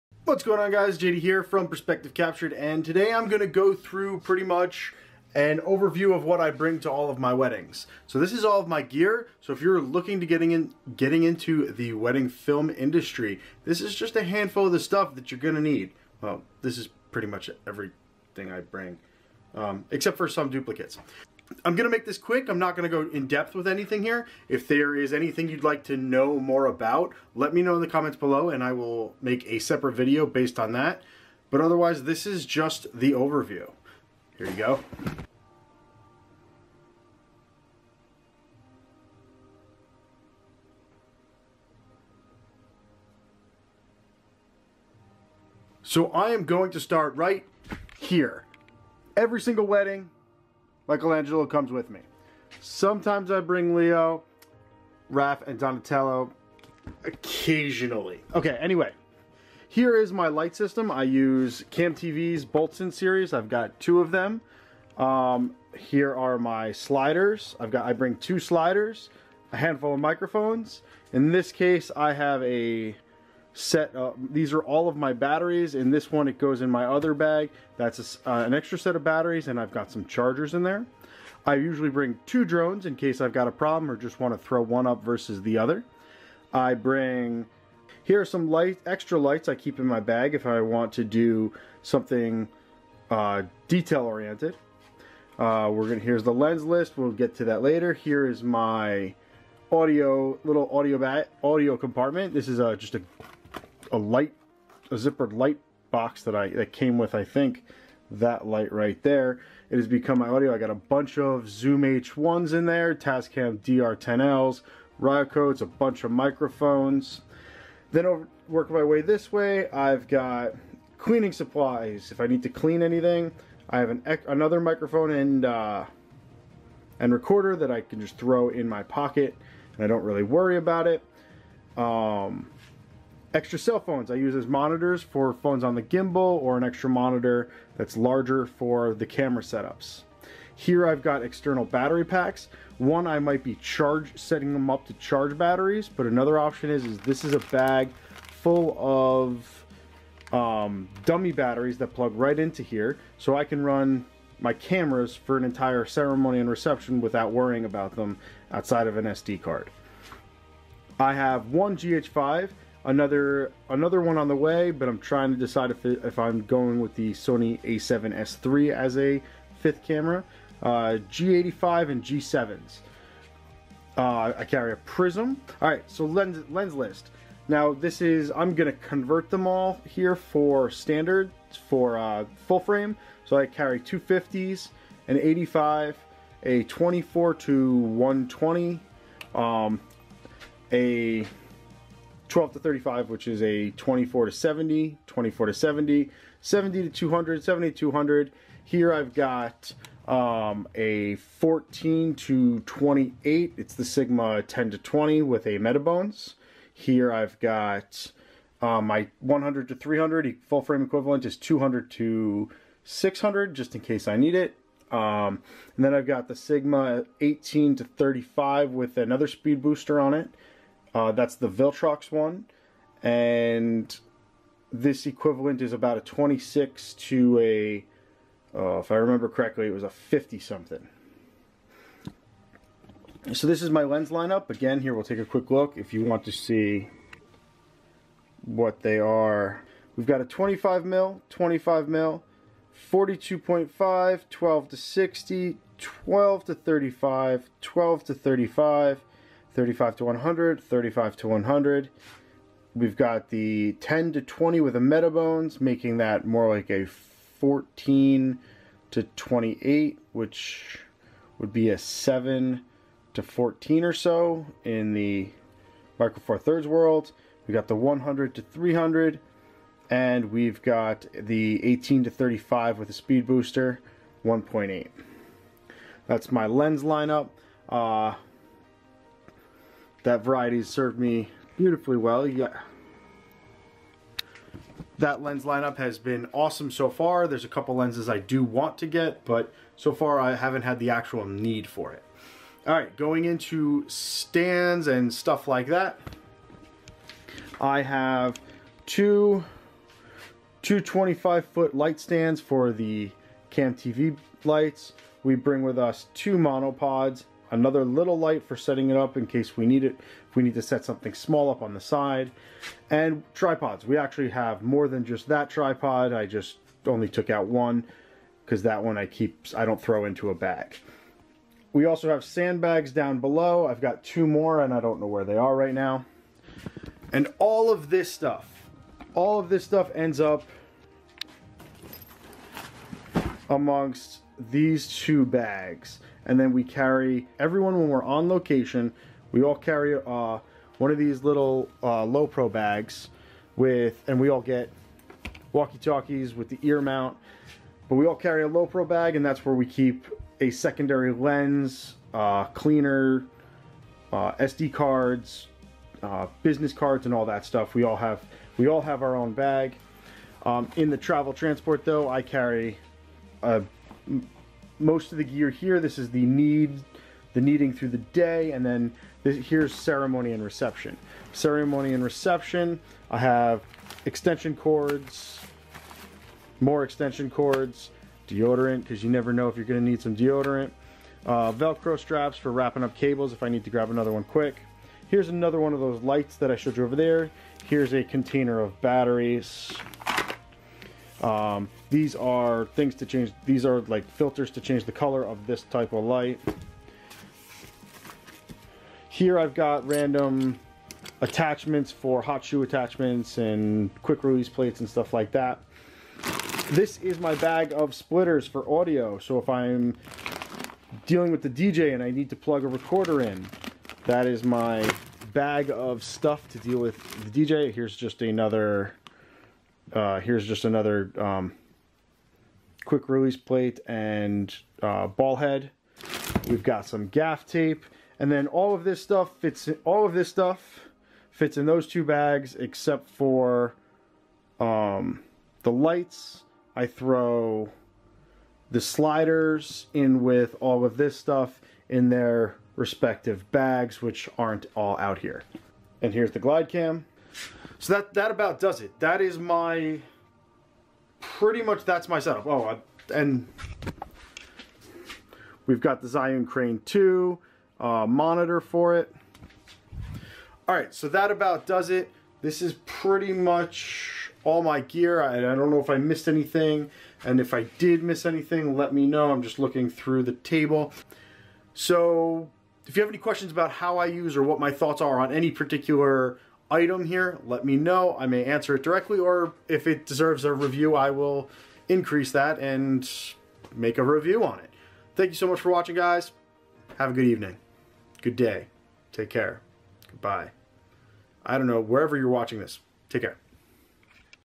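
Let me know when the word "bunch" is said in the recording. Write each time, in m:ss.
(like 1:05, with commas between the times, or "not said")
1:50, 1:55.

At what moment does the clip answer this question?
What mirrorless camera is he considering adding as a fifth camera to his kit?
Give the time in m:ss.
2:47.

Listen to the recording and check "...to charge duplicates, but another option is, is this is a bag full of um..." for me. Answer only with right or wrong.
wrong.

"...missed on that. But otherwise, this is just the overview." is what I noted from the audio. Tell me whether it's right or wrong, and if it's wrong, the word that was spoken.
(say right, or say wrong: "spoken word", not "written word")
wrong: "based", not "missed".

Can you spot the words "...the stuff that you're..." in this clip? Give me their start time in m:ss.
0:14.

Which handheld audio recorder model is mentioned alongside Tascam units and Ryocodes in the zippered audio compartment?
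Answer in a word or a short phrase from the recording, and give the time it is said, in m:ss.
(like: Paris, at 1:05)
Zoom H1, at 1:51.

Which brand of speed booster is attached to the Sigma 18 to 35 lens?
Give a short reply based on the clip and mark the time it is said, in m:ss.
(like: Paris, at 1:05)
Viltrox, at 3:41.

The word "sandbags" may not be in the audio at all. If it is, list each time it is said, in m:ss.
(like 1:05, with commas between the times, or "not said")
5:22.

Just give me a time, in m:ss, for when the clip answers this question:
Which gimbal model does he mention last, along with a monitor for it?
7:36.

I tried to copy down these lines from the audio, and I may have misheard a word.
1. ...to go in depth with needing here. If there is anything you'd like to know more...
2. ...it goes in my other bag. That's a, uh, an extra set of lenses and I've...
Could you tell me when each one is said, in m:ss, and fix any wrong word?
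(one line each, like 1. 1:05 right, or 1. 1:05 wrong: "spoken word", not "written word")
1. 0:22 wrong: "anything", not "needing"
2. 1:16 wrong: "batteries", not "lenses".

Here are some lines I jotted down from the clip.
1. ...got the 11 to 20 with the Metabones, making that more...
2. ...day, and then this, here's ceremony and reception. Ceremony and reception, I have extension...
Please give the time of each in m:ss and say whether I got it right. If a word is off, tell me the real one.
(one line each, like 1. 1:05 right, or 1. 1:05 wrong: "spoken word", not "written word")
1. 4:12 wrong: "10", not "11"
2. 6:07 right.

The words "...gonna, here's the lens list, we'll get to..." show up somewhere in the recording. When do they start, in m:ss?
1:35.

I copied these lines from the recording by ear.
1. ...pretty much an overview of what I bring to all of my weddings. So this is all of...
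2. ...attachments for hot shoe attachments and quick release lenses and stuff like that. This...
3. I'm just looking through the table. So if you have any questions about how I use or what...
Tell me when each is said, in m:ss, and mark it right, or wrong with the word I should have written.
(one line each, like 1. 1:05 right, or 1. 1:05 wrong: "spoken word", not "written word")
1. 0:04 right
2. 6:41 wrong: "plates", not "lenses"
3. 7:49 right.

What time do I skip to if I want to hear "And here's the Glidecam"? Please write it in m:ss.
7:26.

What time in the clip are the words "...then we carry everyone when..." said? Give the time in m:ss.
5:36.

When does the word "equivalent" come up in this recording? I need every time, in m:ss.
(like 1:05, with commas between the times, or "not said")
3:30, 3:45.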